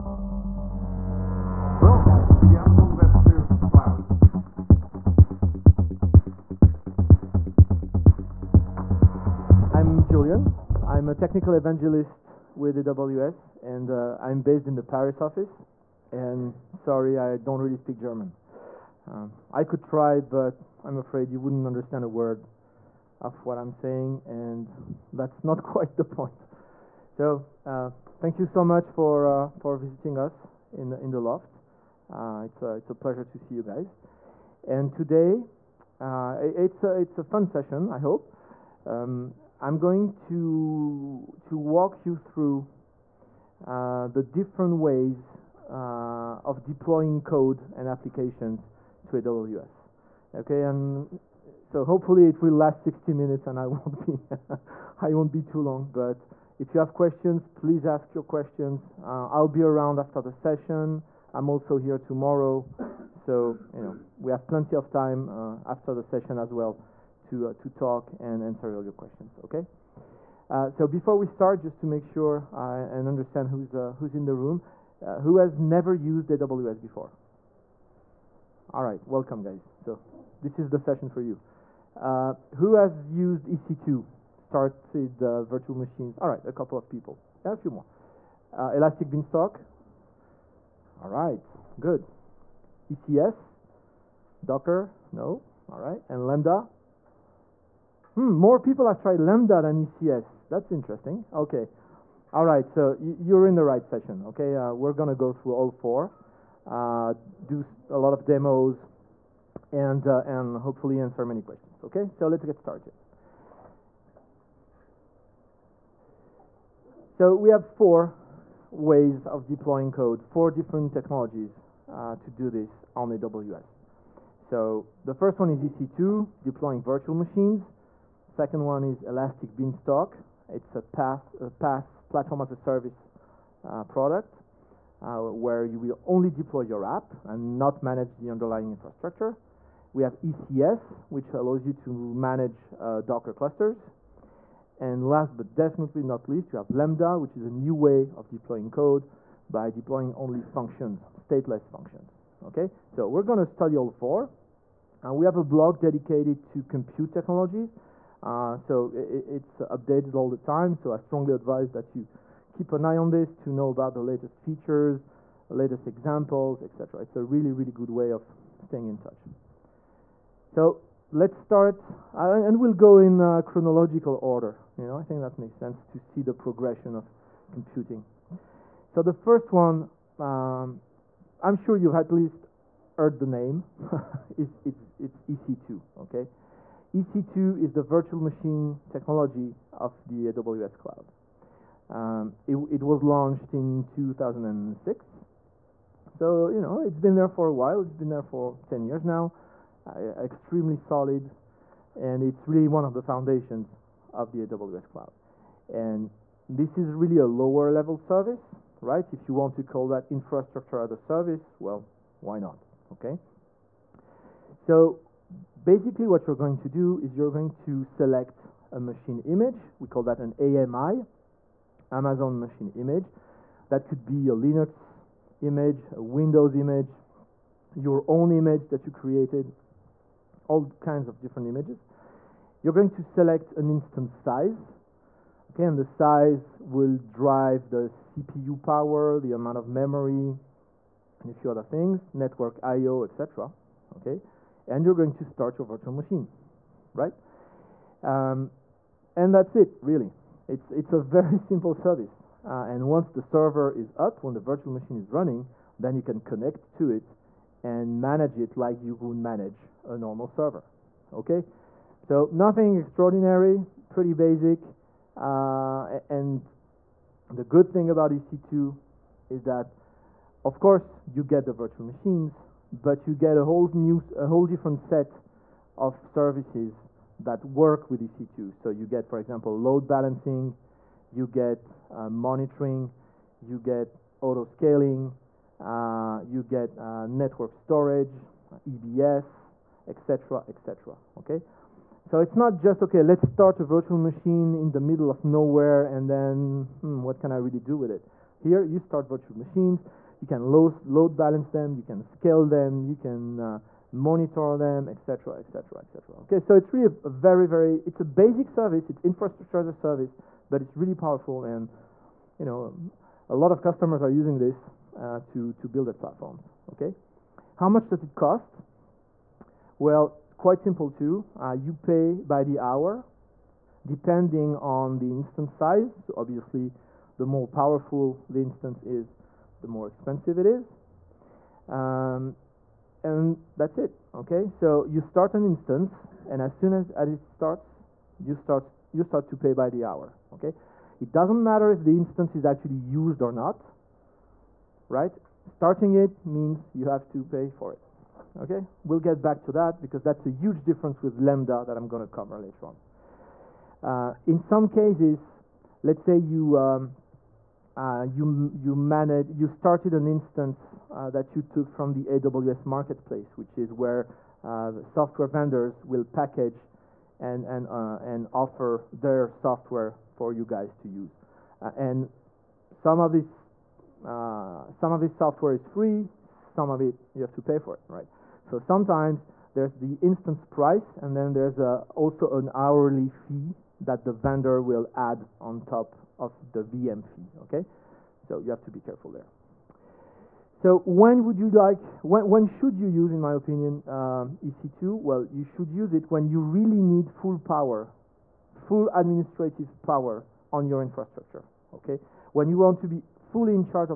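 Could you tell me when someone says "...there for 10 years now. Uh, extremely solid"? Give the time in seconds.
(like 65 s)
198 s.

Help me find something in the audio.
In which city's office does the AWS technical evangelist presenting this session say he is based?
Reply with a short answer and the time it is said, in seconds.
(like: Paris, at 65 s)
Paris, at 14 s.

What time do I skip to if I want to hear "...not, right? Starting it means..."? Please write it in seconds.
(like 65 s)
343 s.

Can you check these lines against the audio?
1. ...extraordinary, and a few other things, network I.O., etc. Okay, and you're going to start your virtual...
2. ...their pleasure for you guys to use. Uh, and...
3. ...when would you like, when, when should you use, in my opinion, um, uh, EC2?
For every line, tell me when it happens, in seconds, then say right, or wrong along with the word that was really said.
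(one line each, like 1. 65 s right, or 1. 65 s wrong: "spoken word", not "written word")
1. 239 s wrong: "memory", not "extraordinary"
2. 368 s wrong: "software", not "pleasure"
3. 390 s right.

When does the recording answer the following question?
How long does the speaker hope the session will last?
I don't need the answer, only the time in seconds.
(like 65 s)
52 s.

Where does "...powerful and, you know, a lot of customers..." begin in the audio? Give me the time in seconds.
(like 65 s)
310 s.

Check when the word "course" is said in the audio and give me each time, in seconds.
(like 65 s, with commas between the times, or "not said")
270 s.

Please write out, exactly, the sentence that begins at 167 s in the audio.
It's a really, really good way of staying in touch.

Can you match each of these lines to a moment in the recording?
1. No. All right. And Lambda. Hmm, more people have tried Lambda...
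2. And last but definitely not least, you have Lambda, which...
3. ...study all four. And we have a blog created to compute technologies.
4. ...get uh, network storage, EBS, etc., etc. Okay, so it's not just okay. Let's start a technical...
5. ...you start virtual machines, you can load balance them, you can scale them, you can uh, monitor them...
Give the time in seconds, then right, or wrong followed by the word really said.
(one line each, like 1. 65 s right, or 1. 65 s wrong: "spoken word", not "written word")
1. 95 s right
2. 144 s right
3. 153 s wrong: "dedicated", not "created"
4. 286 s wrong: "virtual", not "technical"
5. 298 s right.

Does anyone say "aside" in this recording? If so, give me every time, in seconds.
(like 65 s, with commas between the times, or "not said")
not said.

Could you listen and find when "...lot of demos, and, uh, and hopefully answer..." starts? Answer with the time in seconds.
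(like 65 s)
107 s.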